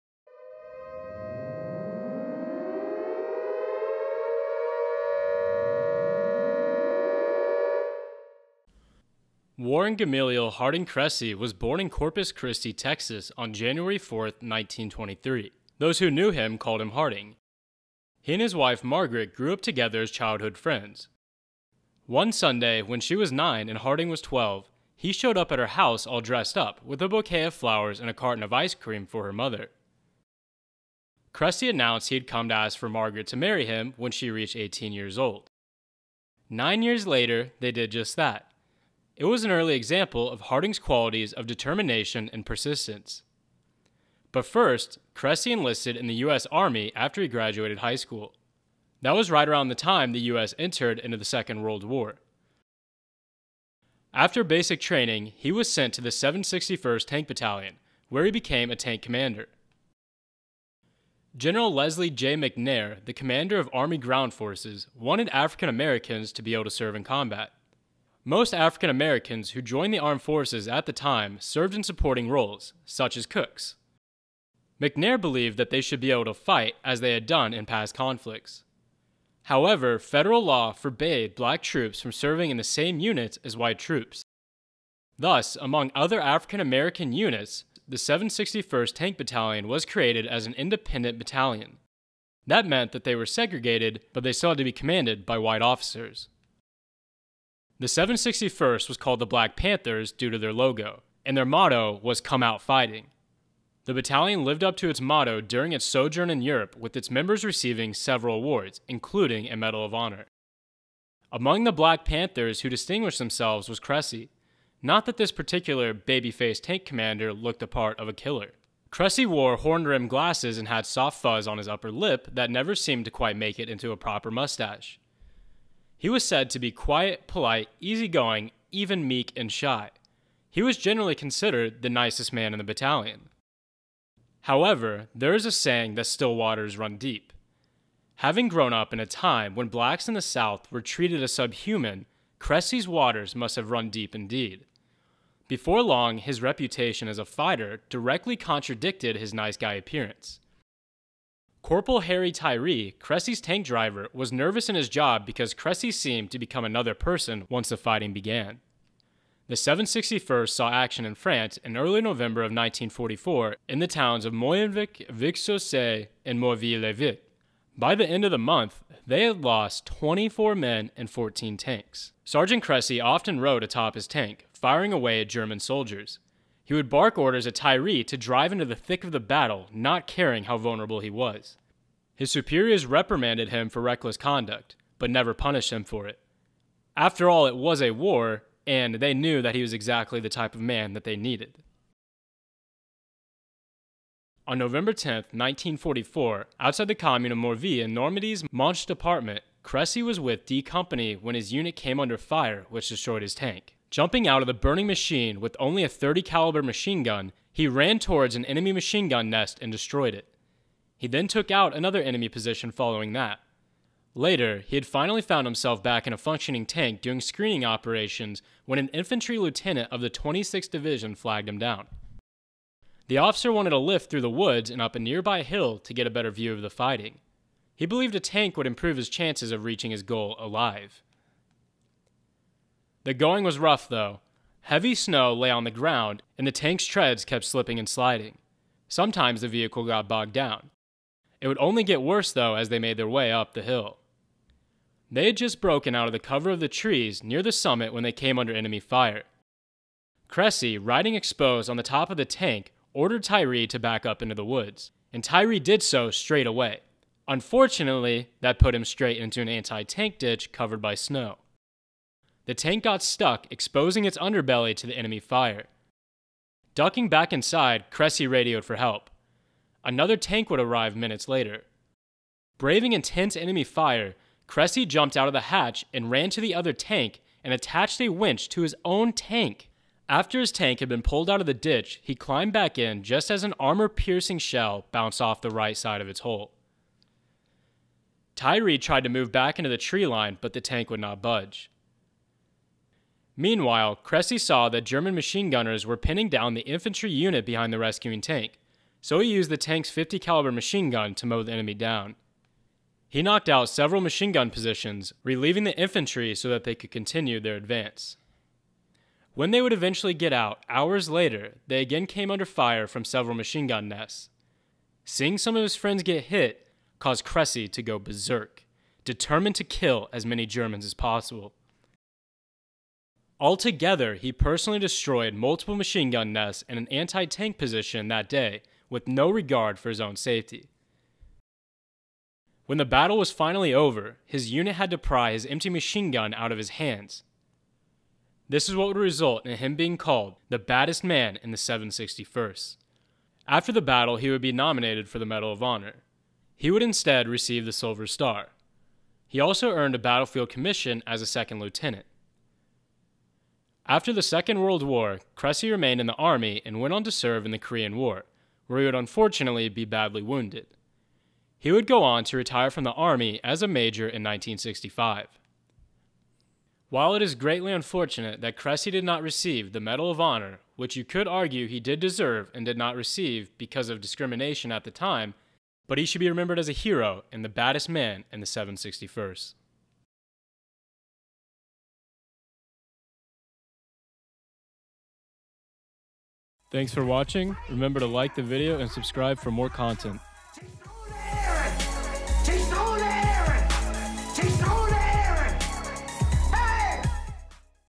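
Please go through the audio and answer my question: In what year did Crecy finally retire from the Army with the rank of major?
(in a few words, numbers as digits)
1965.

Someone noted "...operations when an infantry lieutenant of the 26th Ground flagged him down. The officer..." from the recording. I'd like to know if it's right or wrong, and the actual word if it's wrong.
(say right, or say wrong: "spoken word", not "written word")
wrong: "Division", not "Ground".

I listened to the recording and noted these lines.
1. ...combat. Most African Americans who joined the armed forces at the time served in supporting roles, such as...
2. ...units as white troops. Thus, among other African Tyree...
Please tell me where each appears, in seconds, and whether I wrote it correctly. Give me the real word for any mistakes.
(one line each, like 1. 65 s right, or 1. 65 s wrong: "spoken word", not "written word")
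1. 67 s right
2. 82 s wrong: "American", not "Tyree".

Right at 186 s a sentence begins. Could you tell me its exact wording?
After all, it was a war, and they knew that he was exactly the type of man that they needed.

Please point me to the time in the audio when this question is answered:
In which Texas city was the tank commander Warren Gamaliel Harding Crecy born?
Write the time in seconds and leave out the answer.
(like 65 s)
11 s.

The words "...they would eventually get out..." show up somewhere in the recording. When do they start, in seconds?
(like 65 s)
309 s.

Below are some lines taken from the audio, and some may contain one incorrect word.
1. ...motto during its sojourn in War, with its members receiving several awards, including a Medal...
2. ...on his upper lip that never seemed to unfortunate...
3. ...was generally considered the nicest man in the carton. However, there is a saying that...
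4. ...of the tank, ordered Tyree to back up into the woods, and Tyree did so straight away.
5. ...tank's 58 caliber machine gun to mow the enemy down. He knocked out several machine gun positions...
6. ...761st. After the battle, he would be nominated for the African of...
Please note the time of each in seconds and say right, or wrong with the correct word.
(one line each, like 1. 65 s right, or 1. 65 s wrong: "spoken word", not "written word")
1. 105 s wrong: "Europe", not "War"
2. 121 s wrong: "quite", not "unfortunate"
3. 130 s wrong: "battalion", not "carton"
4. 252 s right
5. 299 s wrong: "50", not "58"
6. 341 s wrong: "Medal", not "African".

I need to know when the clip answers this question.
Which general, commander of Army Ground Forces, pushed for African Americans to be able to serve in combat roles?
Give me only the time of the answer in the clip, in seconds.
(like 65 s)
61 s.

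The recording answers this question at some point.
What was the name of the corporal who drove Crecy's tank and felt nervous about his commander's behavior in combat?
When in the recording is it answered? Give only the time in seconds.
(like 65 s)
152 s.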